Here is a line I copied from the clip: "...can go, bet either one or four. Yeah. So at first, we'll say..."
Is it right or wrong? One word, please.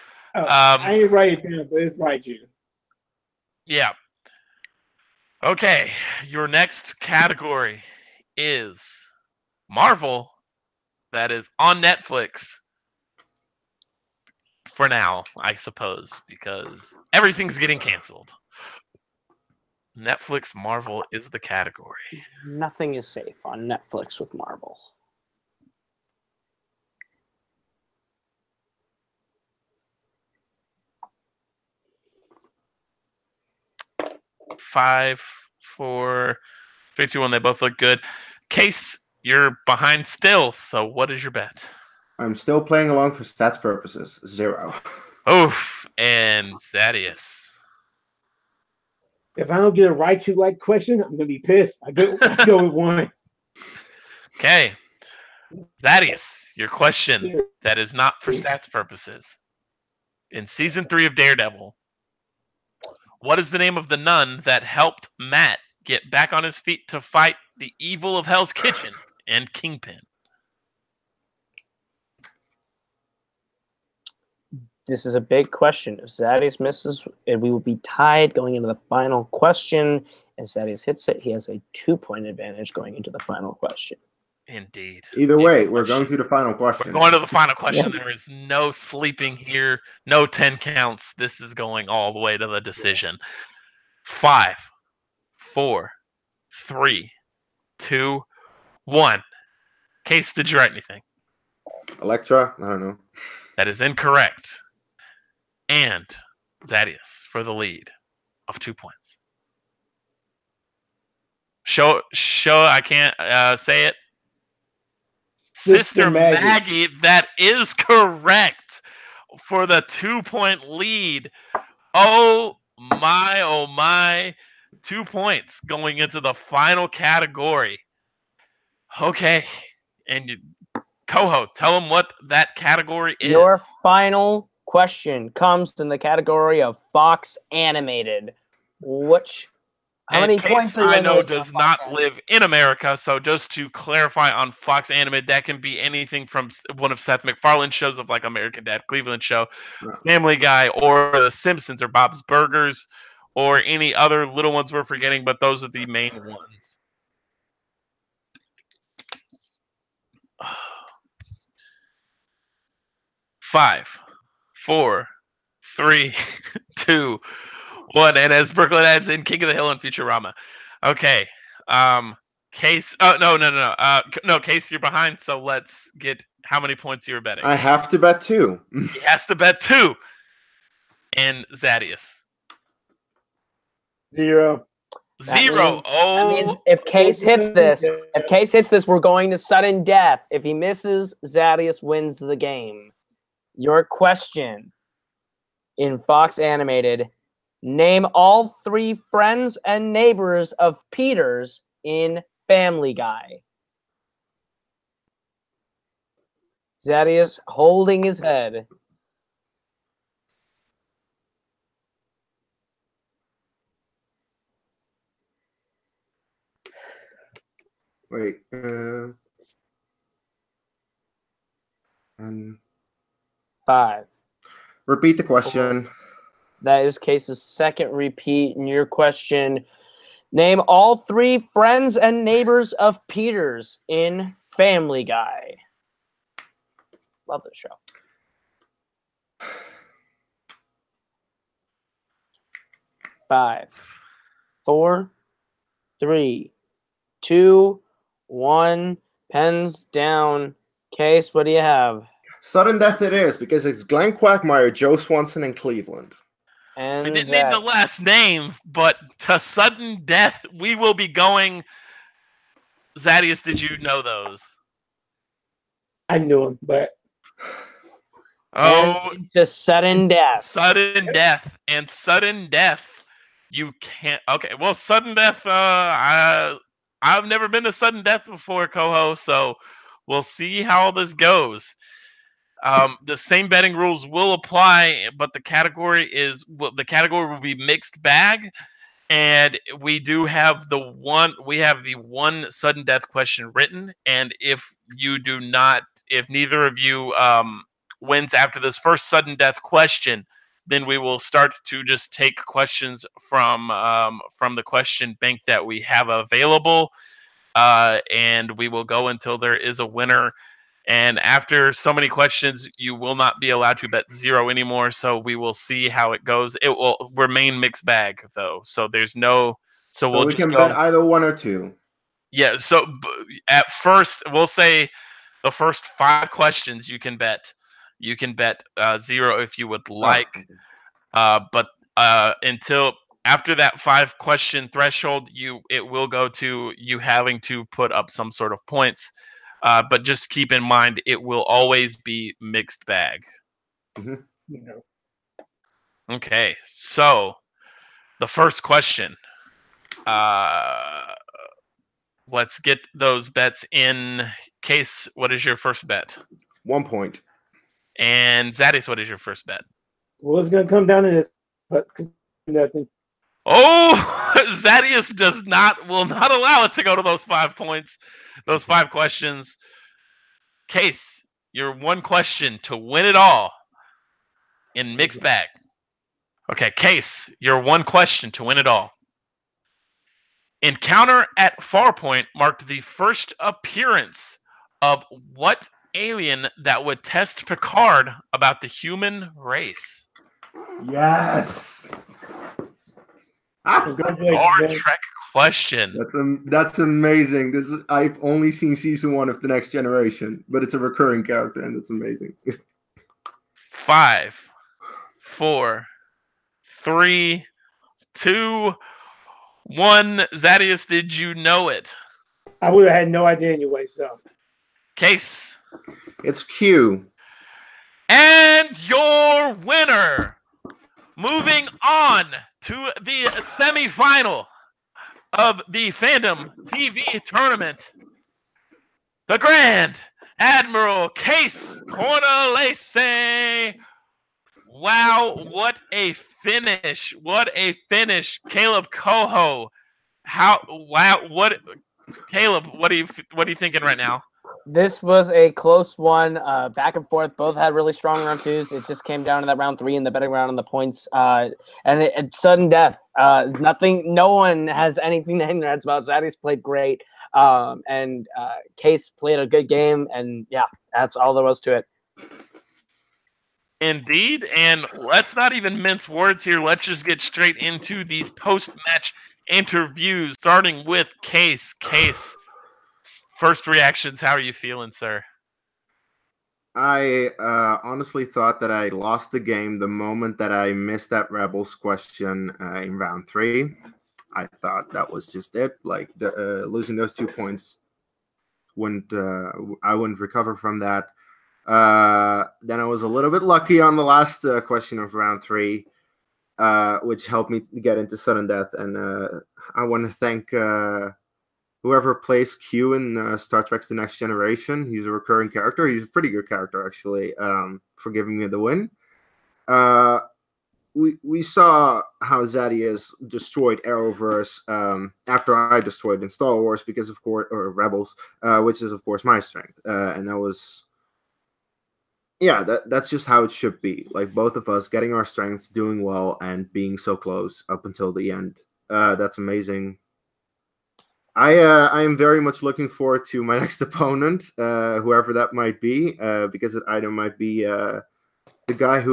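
wrong.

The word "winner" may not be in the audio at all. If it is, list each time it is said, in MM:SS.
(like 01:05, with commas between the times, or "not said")
05:09, 06:59.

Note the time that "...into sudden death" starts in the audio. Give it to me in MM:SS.
08:17.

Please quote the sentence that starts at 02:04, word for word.
Two points going into the final category.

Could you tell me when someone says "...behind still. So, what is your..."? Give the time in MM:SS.
00:39.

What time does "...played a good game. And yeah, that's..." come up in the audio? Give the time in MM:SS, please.
07:39.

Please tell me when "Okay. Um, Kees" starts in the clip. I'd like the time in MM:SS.
02:50.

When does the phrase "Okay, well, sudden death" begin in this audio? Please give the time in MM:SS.
04:34.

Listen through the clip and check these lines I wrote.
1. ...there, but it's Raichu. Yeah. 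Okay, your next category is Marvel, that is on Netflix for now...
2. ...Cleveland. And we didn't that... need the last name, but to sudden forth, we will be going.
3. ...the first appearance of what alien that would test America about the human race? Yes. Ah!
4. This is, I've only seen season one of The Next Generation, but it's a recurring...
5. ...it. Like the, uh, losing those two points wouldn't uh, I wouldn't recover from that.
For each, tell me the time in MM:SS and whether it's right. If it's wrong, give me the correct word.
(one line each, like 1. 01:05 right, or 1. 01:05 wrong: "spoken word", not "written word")
1. 00:01 right
2. 04:15 wrong: "death", not "forth"
3. 06:22 wrong: "Picard", not "America"
4. 06:37 right
5. 08:05 right.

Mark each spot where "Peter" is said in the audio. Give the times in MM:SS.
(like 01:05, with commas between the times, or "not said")
03:20, 03:53.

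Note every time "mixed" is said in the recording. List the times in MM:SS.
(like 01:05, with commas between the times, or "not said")
04:47, 05:17, 05:42, 06:14.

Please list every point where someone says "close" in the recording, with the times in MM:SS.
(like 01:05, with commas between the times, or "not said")
07:25, 08:47.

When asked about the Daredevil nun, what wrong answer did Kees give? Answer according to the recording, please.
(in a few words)
Elektra.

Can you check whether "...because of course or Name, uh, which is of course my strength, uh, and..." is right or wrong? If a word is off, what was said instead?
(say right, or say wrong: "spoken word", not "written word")
wrong: "Rebels", not "Name".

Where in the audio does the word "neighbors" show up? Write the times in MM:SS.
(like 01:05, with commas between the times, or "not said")
03:19, 03:52.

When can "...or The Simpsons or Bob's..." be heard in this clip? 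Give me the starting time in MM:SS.
02:30.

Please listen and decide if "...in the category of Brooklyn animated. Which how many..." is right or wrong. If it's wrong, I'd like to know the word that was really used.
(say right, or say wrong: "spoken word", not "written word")
wrong: "Fox", not "Brooklyn".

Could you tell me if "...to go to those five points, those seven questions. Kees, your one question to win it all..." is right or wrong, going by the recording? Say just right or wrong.
wrong.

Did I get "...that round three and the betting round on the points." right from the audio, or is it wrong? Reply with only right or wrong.
right.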